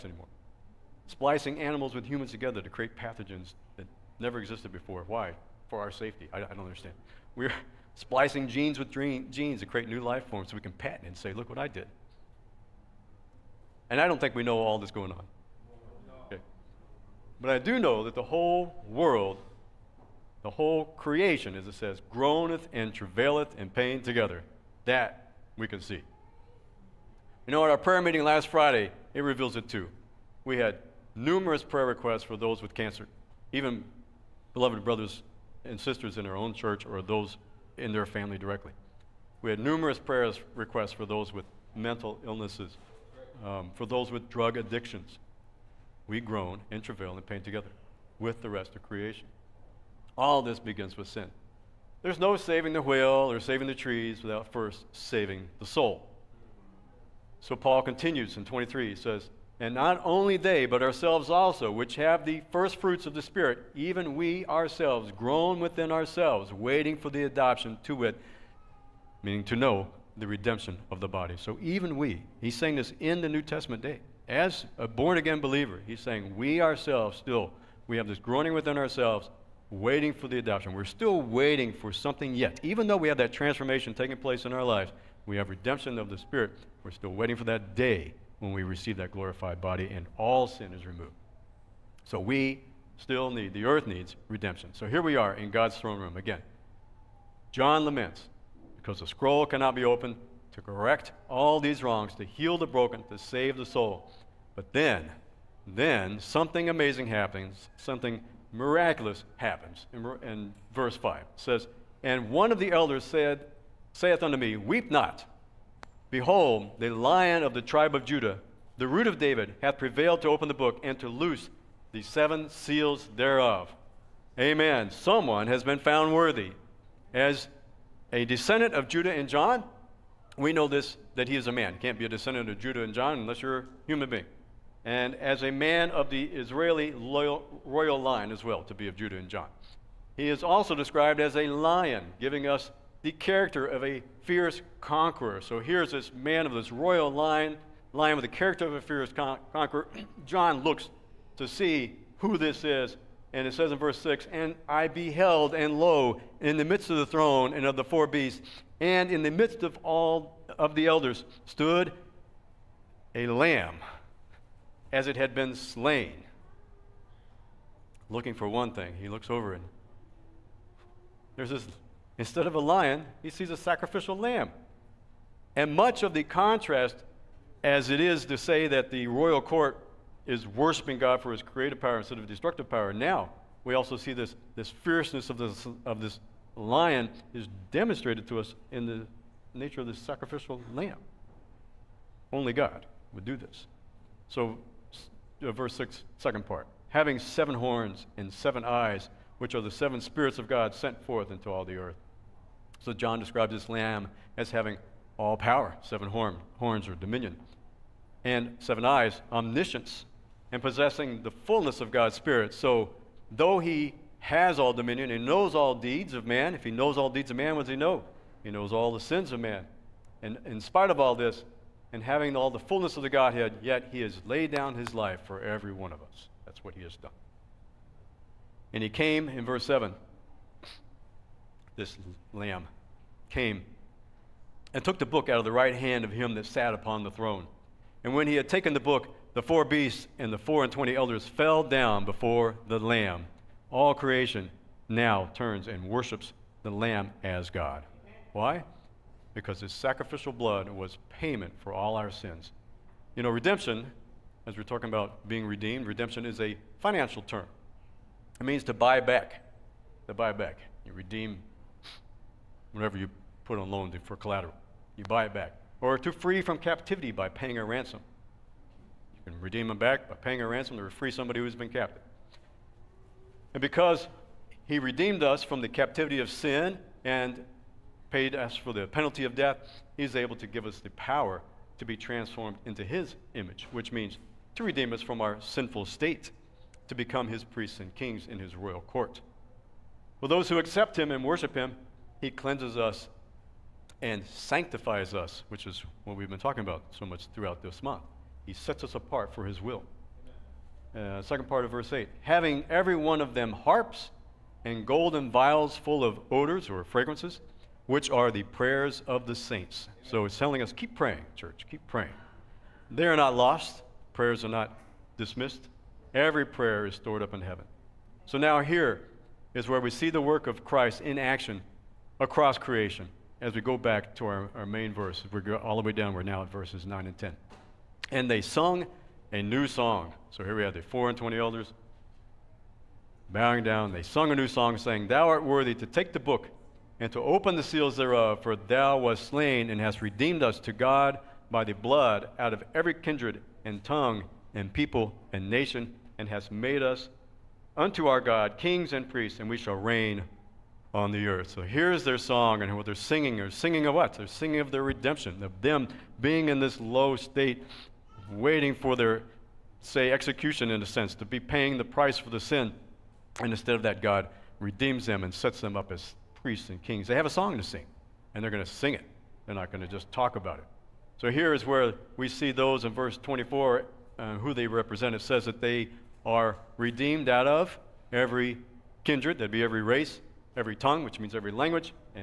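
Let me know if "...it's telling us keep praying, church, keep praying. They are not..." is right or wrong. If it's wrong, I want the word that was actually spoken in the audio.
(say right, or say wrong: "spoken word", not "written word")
right.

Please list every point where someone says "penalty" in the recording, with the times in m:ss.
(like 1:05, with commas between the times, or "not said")
4:38.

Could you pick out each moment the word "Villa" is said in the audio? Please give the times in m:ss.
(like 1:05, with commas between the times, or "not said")
not said.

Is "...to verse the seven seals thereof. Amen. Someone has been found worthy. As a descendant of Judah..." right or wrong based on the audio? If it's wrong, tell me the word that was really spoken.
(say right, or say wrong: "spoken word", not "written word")
wrong: "loose", not "verse".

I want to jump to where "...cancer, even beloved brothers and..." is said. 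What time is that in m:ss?
0:32.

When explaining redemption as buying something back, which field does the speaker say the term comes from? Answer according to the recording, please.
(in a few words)
financial.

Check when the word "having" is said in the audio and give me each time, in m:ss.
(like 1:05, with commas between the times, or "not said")
3:16, 3:24, 3:42, 5:02.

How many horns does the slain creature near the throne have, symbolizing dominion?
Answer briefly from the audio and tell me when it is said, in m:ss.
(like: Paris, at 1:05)
7, at 3:17.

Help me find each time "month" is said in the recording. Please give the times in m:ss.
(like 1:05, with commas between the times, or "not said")
4:57.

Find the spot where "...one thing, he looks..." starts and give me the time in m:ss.
2:48.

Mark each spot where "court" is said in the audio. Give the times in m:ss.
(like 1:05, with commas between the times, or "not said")
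2:59, 4:48.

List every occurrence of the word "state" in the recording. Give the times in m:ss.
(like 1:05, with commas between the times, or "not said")
4:45, 5:57.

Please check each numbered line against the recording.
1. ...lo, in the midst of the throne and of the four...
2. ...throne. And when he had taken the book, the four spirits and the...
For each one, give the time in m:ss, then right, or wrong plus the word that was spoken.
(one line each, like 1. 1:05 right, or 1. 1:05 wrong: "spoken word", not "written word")
1. 2:35 right
2. 3:57 wrong: "beasts", not "spirits".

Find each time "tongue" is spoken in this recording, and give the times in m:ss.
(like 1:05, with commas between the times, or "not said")
5:43, 6:20.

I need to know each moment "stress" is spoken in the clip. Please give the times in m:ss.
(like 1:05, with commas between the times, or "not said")
not said.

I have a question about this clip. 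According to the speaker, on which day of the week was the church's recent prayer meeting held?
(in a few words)
Friday.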